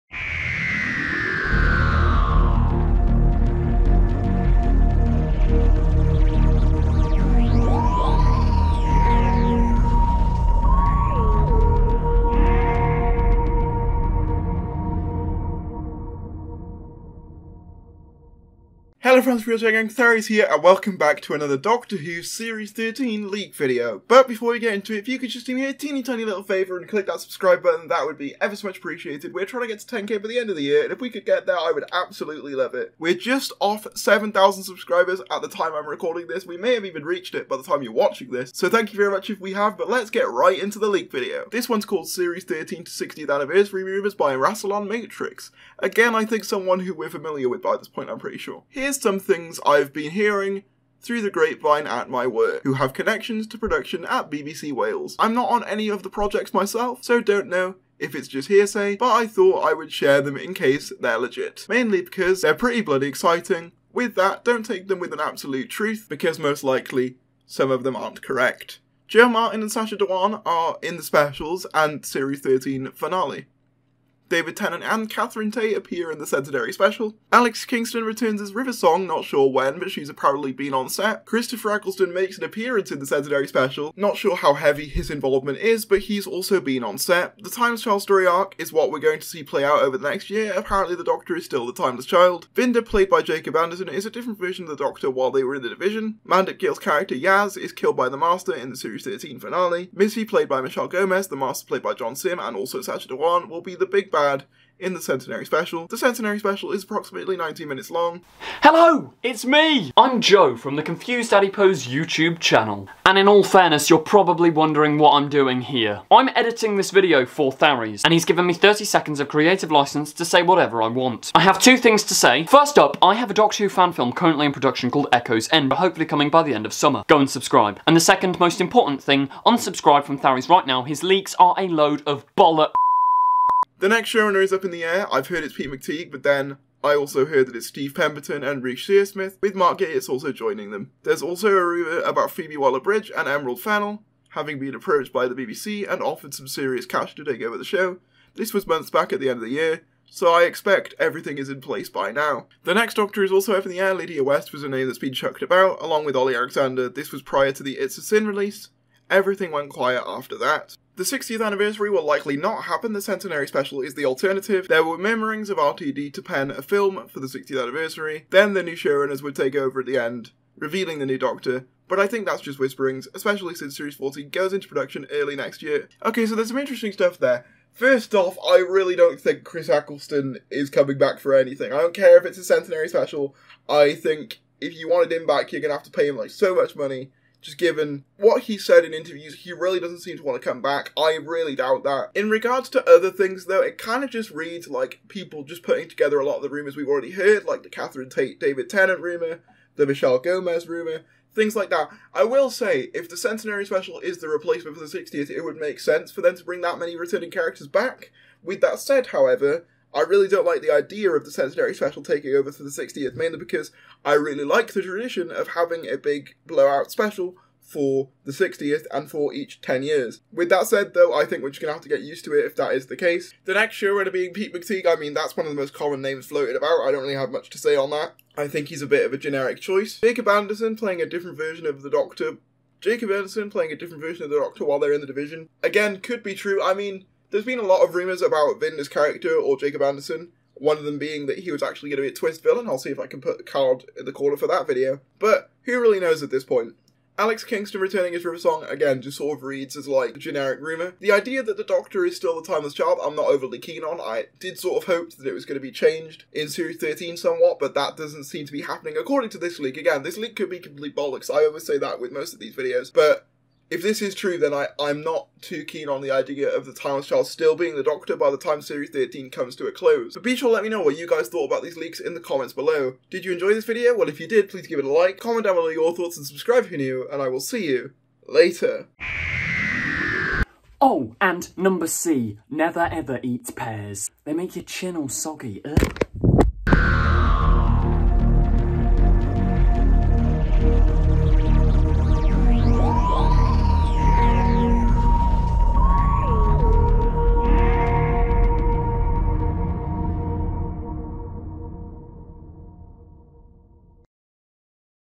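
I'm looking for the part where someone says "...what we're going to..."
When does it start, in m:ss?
1:28.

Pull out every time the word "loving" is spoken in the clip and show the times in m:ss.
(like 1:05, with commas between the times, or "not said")
not said.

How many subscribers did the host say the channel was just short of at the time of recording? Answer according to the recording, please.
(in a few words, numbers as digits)
7,000.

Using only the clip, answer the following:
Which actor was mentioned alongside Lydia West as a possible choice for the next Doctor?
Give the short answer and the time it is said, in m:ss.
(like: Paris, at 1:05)
Ollie Alexander, at 2:36.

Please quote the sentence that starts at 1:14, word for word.
David Tennant and Catherine Tate appear in the Centenary special.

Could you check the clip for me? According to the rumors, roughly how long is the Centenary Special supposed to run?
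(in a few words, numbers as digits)
19 minutes.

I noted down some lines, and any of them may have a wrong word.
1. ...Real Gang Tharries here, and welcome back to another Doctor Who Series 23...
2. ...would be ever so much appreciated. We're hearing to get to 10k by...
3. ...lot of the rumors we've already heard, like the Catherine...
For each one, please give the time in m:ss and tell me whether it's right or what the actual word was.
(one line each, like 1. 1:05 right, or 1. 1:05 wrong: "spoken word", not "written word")
1. 0:19 wrong: "13", not "23"
2. 0:28 wrong: "trying", not "hearing"
3. 3:16 right.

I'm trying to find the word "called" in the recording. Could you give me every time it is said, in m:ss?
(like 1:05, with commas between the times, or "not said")
0:41, 2:04.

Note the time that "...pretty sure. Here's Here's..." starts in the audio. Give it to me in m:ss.
0:48.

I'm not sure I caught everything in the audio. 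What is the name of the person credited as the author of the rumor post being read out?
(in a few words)
Rassilon Matrix.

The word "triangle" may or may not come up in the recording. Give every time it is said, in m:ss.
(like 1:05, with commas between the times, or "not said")
not said.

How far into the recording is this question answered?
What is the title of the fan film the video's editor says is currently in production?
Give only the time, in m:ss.
2:05.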